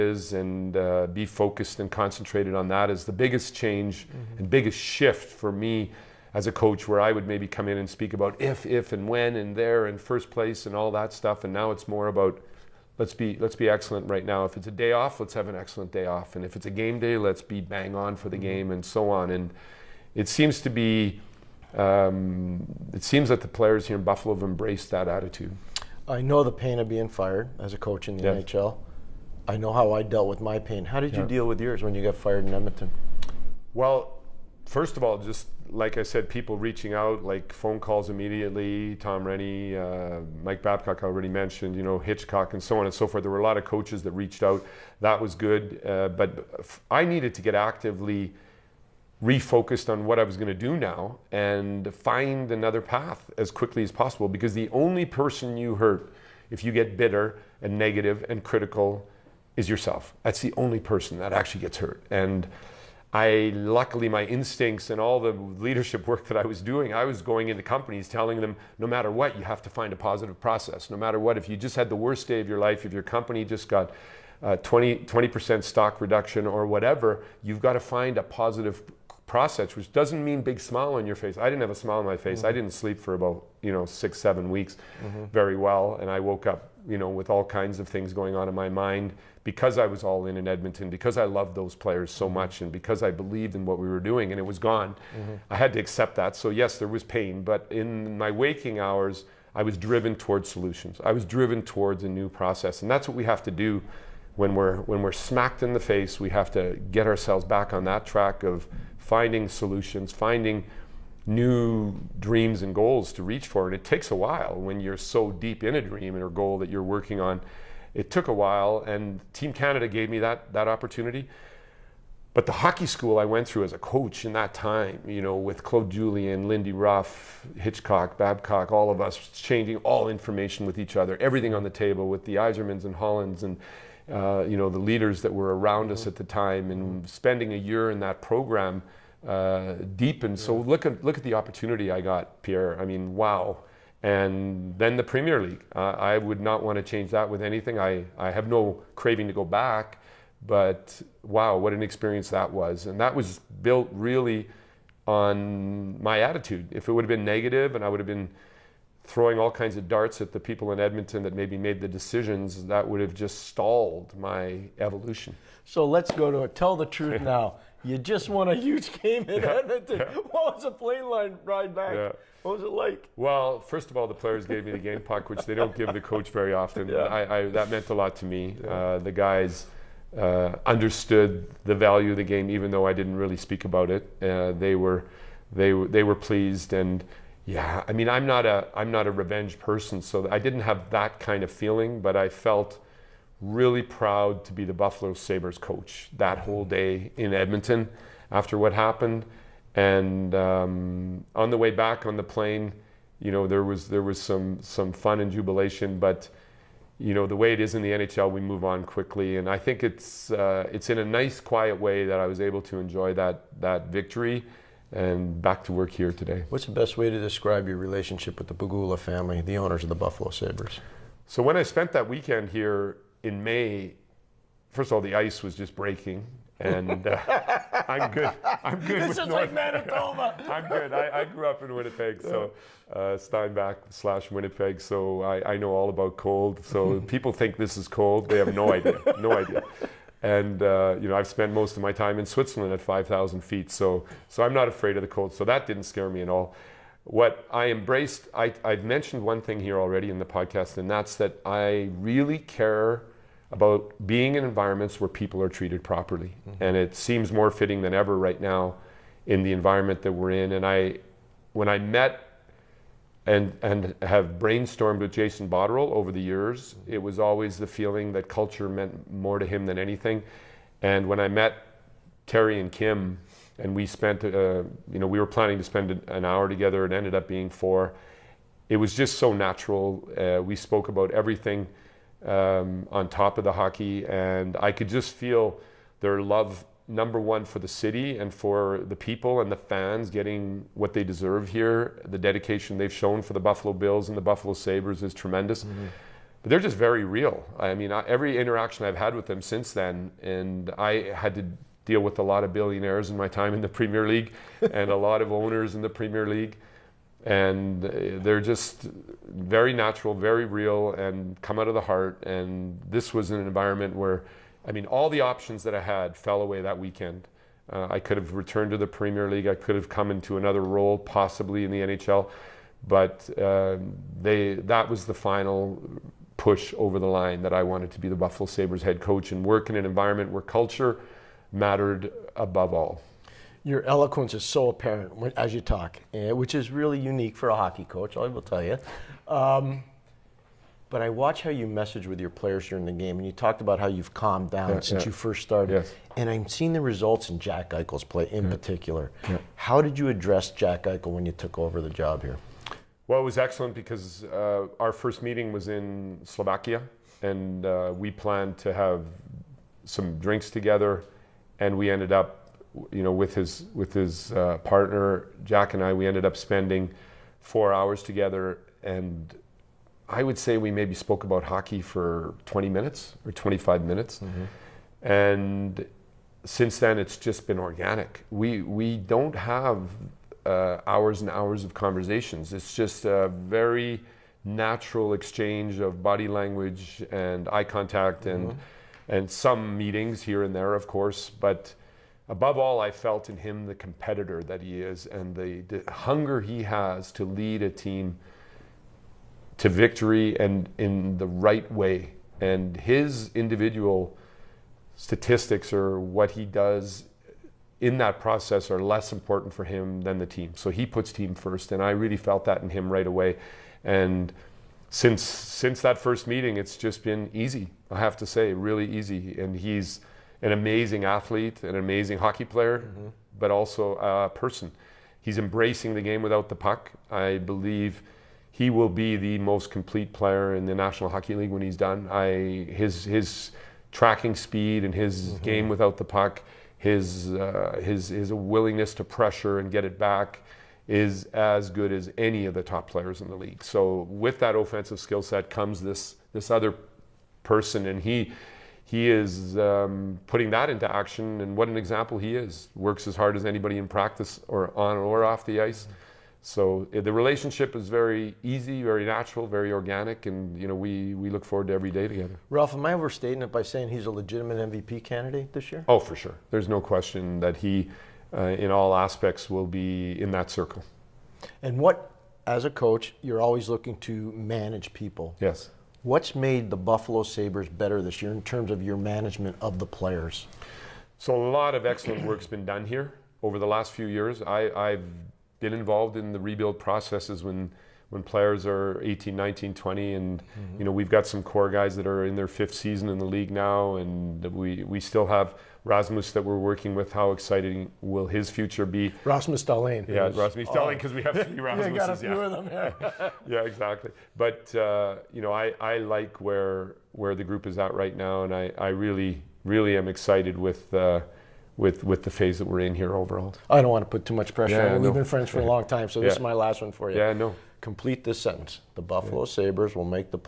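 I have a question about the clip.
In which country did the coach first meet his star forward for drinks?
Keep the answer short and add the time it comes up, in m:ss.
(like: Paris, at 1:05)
Slovakia, at 5:56.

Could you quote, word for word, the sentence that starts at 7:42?
Ralph, am I overstating it by saying he's a legitimate MVP candidate this year?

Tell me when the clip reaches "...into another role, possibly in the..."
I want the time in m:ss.
5:20.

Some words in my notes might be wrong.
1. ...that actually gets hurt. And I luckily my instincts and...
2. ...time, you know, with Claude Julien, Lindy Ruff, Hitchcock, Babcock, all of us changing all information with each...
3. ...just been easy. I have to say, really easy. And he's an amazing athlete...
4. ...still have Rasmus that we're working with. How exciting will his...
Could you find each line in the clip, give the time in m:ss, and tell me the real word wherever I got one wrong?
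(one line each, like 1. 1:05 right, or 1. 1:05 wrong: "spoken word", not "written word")
1. 1:01 right
2. 2:04 right
3. 6:56 right
4. 8:14 right.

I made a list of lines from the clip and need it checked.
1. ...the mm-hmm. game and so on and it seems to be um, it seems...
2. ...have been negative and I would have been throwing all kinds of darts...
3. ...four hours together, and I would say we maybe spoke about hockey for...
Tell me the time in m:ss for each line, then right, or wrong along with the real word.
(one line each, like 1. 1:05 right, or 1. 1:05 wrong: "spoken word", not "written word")
1. 0:18 right
2. 2:37 right
3. 6:07 right.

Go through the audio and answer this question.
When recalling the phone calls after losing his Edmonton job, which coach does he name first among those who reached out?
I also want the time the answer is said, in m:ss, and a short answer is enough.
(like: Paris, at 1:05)
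Tom Renney, at 0:38.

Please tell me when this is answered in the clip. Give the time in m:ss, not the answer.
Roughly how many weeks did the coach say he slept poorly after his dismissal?
1:23.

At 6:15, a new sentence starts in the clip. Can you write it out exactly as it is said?
and since then it's just been organic.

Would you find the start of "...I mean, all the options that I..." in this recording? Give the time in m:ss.
5:14.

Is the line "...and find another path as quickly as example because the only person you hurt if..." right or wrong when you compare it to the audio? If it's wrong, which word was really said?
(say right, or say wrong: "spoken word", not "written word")
wrong: "possible", not "example".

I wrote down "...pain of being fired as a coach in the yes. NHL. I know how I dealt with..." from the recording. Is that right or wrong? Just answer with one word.
right.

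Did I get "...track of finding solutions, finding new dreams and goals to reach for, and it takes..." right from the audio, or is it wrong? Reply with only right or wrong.
right.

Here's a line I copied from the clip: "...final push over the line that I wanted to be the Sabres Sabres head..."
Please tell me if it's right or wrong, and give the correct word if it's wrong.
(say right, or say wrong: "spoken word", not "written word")
wrong: "Buffalo", not "Sabres".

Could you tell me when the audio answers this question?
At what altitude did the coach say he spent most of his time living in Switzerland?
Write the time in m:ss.
4:02.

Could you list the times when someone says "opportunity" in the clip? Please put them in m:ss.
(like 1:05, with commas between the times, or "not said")
2:00, 2:21.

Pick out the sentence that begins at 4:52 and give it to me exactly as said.
The dedication they've shown for the Buffalo Bills and the Buffalo Sabres is tremendous.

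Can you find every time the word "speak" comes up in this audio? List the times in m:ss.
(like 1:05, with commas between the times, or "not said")
0:07, 3:03.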